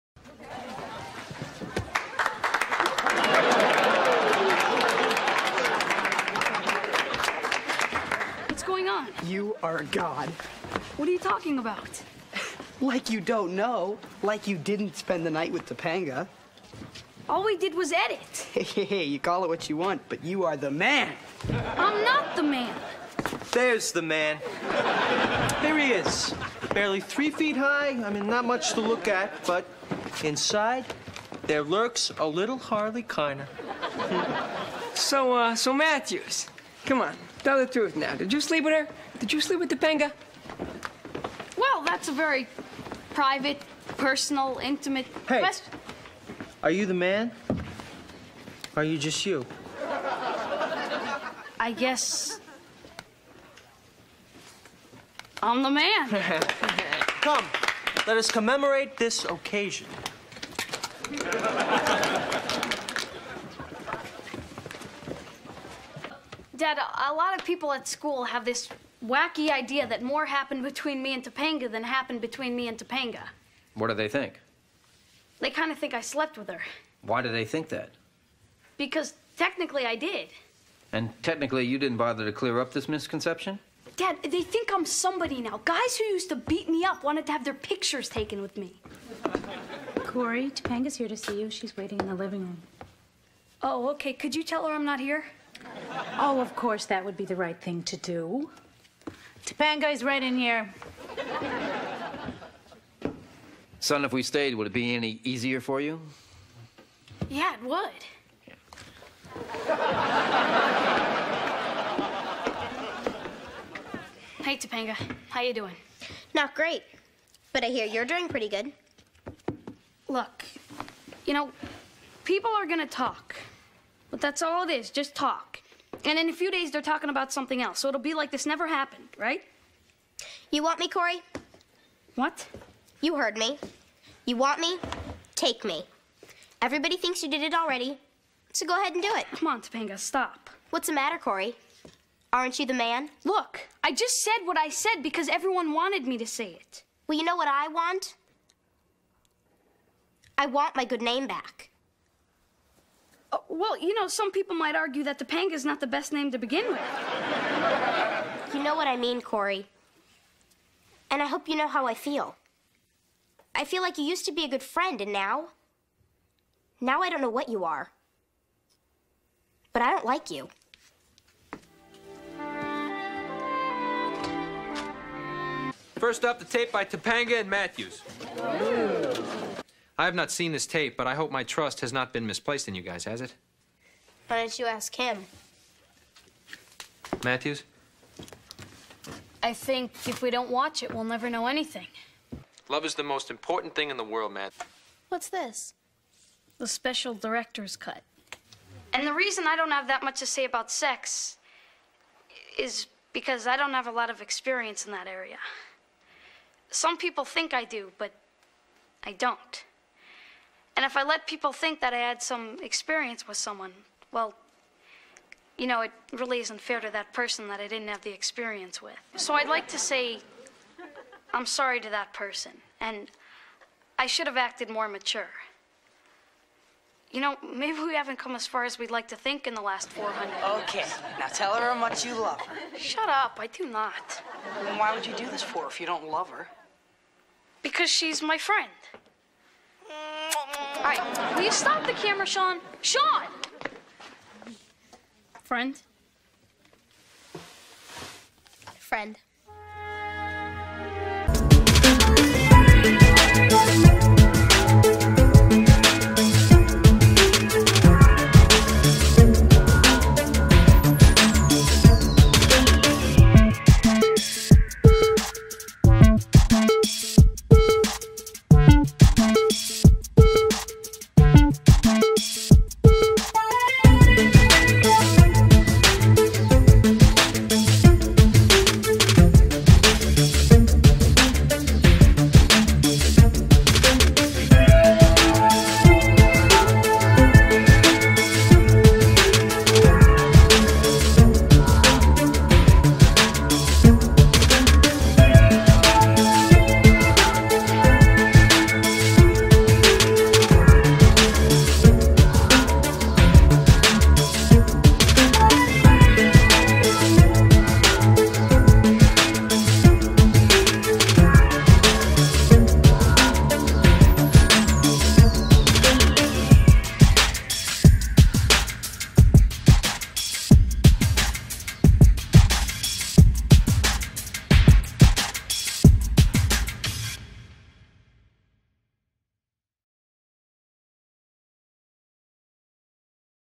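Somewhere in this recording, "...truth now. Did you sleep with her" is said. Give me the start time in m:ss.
0:37.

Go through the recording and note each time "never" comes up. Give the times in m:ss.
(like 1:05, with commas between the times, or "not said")
2:08, 3:11.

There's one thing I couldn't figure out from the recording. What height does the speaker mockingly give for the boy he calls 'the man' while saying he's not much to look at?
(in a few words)
3 feet.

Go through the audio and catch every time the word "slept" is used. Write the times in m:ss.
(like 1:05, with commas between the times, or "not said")
1:16.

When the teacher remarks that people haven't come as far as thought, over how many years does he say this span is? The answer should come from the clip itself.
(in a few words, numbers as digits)
400.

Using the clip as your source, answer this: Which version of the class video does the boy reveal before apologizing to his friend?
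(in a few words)
Special director's cut.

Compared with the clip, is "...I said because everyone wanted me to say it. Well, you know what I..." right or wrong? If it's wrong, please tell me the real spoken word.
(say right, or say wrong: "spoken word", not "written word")
right.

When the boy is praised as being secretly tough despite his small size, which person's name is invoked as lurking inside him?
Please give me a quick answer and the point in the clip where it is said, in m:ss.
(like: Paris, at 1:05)
Harley Keiner, at 0:32.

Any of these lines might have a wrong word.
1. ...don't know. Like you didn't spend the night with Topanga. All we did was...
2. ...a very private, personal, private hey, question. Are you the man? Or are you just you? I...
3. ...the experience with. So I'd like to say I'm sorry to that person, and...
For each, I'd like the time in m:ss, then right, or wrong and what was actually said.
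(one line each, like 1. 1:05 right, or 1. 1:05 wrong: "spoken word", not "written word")
1. 0:13 right
2. 0:42 wrong: "intimate", not "private"
3. 3:38 right.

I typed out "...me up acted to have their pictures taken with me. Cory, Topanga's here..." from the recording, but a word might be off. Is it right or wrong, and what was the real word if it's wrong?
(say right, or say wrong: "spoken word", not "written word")
wrong: "wanted", not "acted".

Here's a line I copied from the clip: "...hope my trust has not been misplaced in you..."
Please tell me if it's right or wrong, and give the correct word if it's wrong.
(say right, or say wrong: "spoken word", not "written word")
right.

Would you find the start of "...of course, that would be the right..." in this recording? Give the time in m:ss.
1:36.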